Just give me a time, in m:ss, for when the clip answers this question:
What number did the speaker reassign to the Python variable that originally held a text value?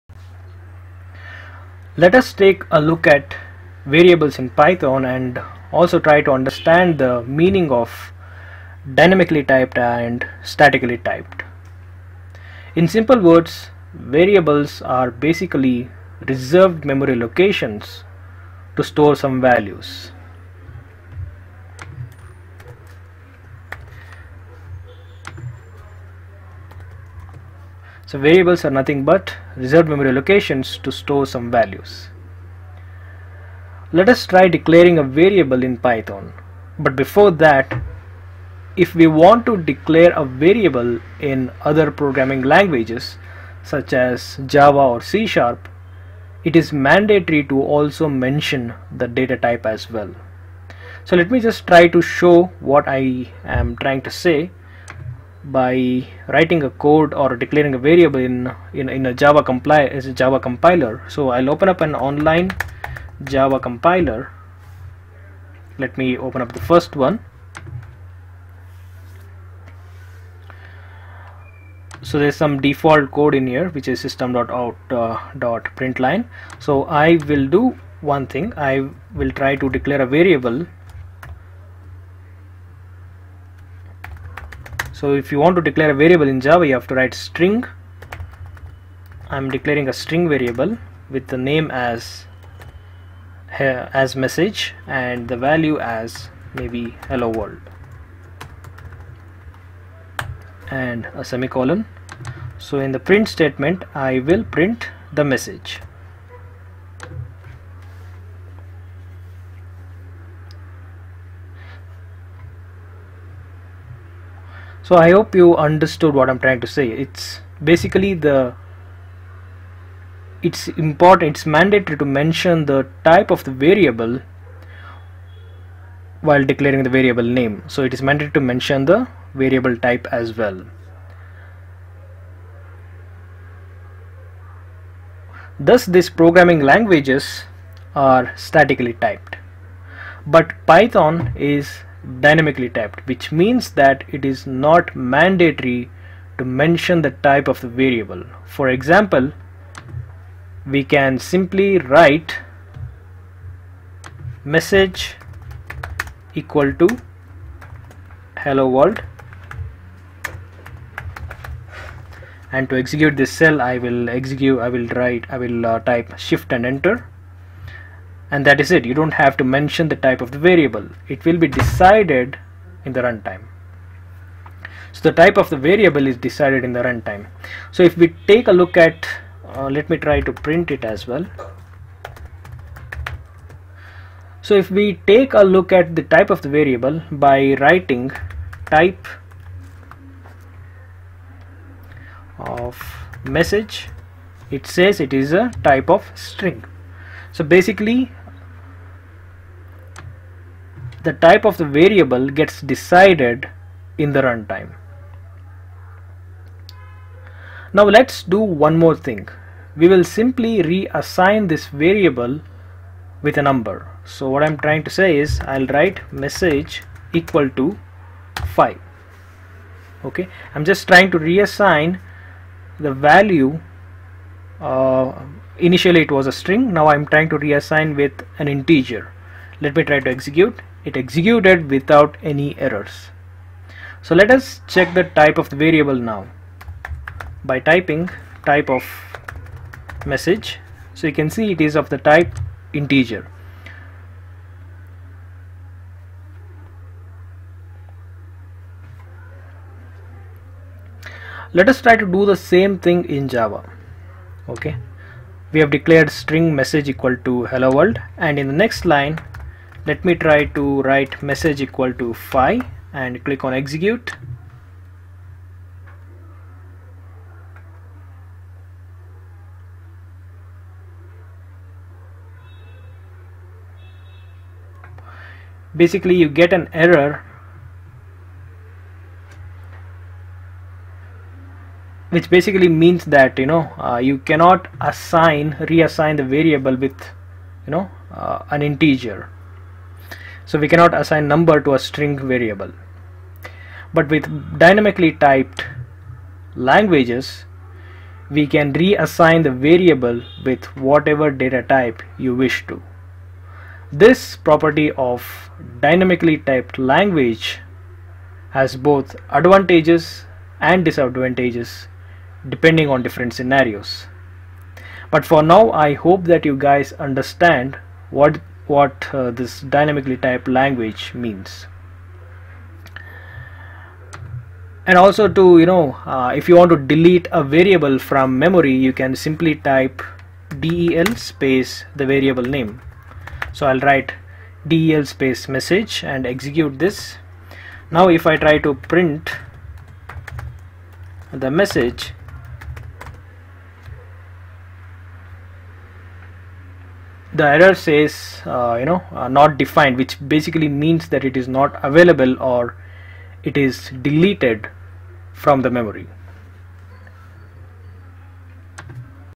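3:38.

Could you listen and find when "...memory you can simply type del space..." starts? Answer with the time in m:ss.
5:28.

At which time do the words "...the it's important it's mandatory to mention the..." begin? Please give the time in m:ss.
1:58.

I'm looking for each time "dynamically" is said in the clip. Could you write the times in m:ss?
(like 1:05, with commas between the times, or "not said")
0:08, 2:22, 4:54, 5:05, 5:19.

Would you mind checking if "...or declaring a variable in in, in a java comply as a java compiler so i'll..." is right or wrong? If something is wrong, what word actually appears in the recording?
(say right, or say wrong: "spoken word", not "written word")
right.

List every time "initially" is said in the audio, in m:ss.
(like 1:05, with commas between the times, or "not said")
3:45.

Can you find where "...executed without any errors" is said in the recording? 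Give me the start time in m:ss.
3:50.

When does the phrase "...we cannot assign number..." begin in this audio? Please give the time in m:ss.
4:50.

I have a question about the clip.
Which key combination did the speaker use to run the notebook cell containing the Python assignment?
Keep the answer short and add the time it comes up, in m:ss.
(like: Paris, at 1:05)
Shift and Enter, at 2:46.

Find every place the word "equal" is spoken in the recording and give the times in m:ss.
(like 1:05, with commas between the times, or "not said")
2:36, 3:37, 4:16, 4:21.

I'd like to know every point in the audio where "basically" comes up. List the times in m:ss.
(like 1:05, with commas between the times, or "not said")
0:15, 1:57, 3:17, 4:35, 4:42, 5:50.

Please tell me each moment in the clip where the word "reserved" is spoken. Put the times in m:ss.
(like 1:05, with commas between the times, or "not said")
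0:16, 0:29.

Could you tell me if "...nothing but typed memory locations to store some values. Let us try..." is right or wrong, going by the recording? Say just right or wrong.
wrong.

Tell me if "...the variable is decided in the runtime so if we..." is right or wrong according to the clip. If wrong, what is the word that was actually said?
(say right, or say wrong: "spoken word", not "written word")
right.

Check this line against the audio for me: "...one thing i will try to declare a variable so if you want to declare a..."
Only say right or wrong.
right.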